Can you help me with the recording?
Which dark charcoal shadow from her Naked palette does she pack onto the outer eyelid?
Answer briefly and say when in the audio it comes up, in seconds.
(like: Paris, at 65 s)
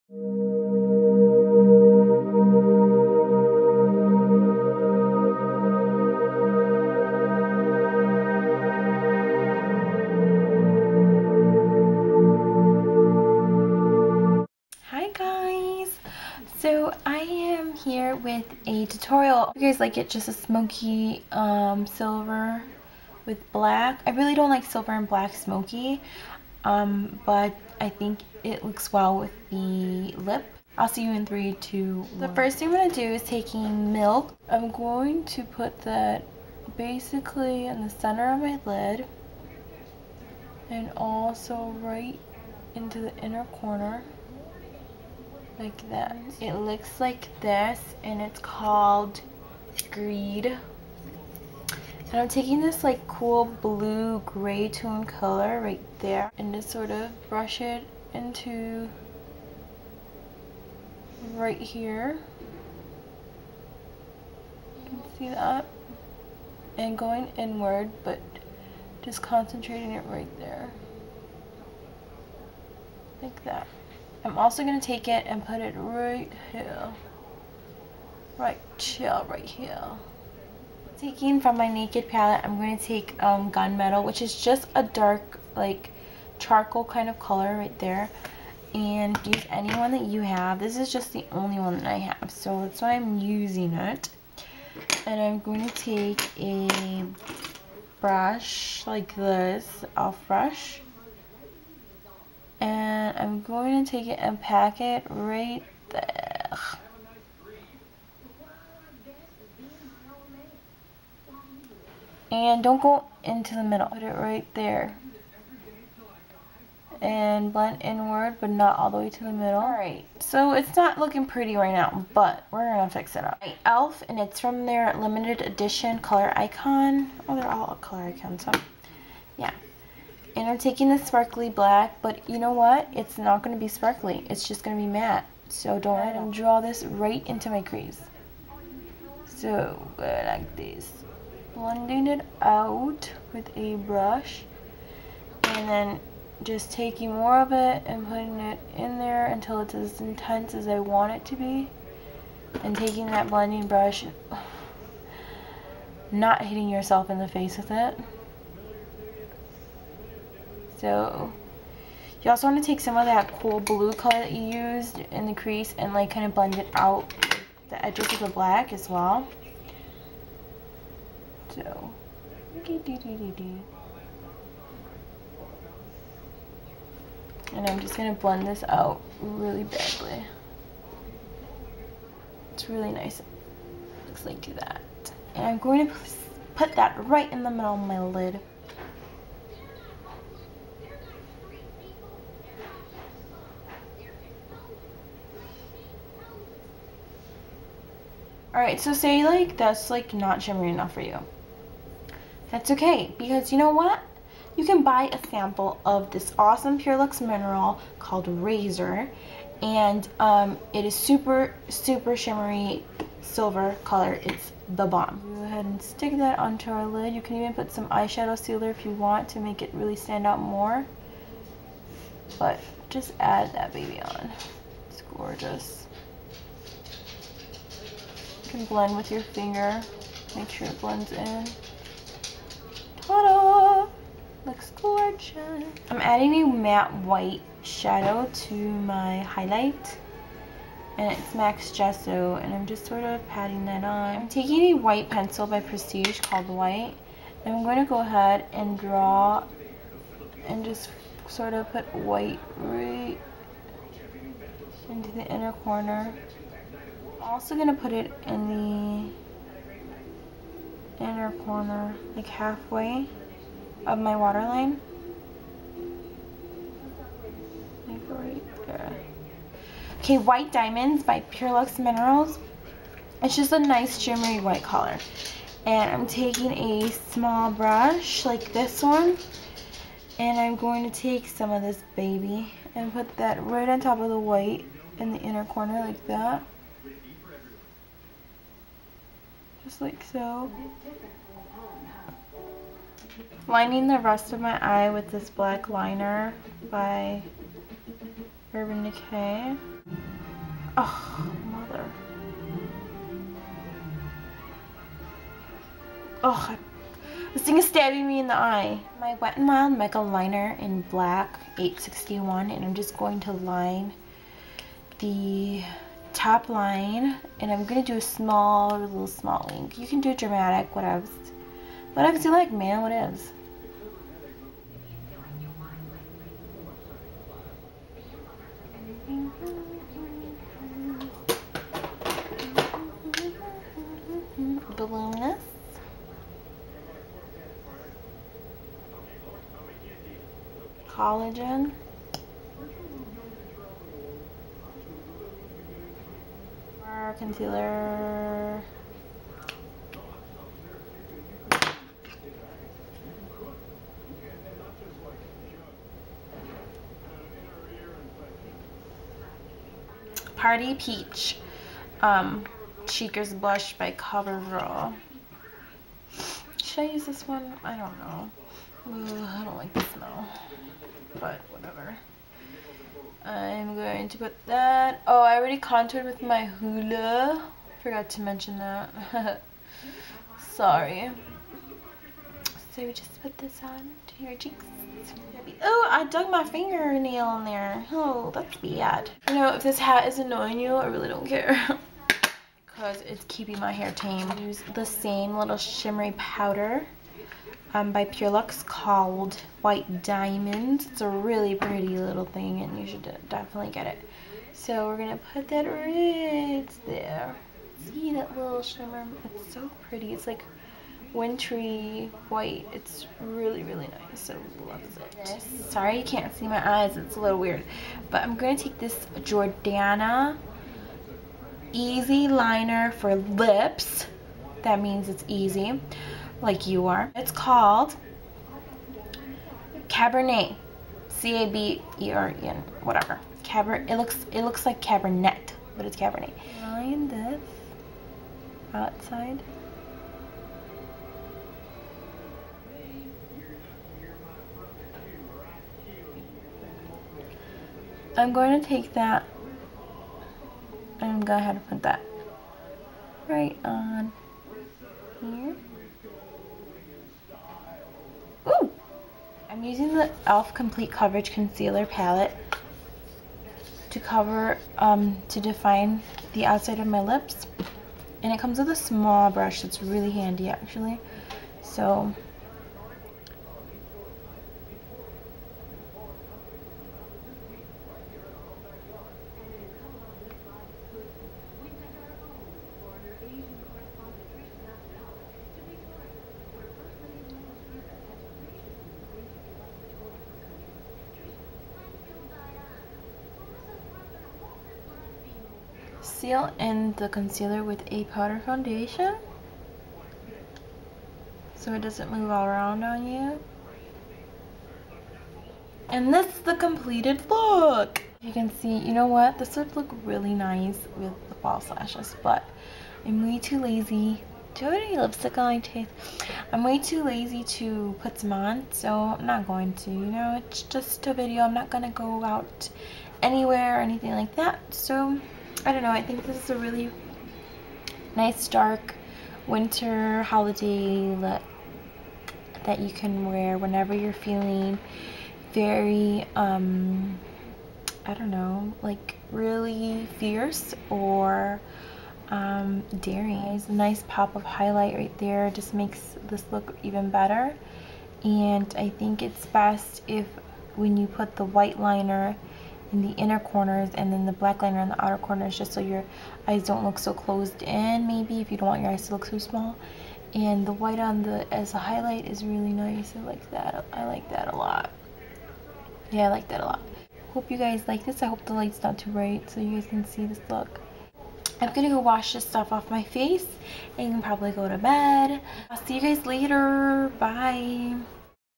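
Gunmetal, at 83 s.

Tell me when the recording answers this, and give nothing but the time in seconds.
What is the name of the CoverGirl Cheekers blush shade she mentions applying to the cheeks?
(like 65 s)
360 s.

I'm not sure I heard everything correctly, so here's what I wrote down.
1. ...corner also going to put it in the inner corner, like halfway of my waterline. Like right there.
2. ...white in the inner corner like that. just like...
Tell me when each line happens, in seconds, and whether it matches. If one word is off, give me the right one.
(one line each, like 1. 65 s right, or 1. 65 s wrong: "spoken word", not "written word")
1. 255 s right
2. 284 s right.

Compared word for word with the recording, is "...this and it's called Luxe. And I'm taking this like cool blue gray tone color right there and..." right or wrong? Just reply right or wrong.
wrong.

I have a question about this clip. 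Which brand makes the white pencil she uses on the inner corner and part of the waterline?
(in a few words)
Prestige.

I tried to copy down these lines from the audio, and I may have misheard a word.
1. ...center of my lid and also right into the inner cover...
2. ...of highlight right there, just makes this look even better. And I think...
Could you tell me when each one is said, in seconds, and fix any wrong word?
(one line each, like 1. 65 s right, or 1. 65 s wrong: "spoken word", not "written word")
1. 37 s wrong: "corner", not "cover"
2. 544 s right.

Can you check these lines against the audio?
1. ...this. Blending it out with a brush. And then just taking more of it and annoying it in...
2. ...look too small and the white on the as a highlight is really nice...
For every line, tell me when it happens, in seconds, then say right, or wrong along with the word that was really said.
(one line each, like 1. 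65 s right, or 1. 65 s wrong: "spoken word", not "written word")
1. 140 s wrong: "putting", not "annoying"
2. 559 s right.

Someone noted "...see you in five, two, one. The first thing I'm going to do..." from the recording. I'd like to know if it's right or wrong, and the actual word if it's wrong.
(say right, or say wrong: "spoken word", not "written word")
wrong: "three", not "five".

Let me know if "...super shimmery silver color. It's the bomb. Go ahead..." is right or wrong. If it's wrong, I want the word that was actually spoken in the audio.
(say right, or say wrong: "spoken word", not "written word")
right.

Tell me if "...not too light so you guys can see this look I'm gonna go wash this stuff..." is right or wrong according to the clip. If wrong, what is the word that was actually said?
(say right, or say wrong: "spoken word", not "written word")
wrong: "bright", not "light".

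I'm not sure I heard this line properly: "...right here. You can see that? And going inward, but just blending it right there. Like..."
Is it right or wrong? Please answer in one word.
wrong.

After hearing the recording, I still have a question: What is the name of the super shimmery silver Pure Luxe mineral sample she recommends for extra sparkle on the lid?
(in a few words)
Razor.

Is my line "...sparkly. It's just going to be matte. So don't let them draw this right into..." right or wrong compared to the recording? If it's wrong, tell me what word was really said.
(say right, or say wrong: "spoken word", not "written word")
right.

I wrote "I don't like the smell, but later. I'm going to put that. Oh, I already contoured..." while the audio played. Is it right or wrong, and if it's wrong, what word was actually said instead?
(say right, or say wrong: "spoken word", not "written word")
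wrong: "whatever", not "later".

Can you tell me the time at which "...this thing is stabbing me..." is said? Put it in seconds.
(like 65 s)
307 s.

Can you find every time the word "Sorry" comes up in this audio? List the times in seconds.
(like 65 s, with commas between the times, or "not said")
380 s, 415 s.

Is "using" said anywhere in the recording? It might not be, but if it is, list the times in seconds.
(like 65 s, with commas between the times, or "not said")
93 s, 459 s.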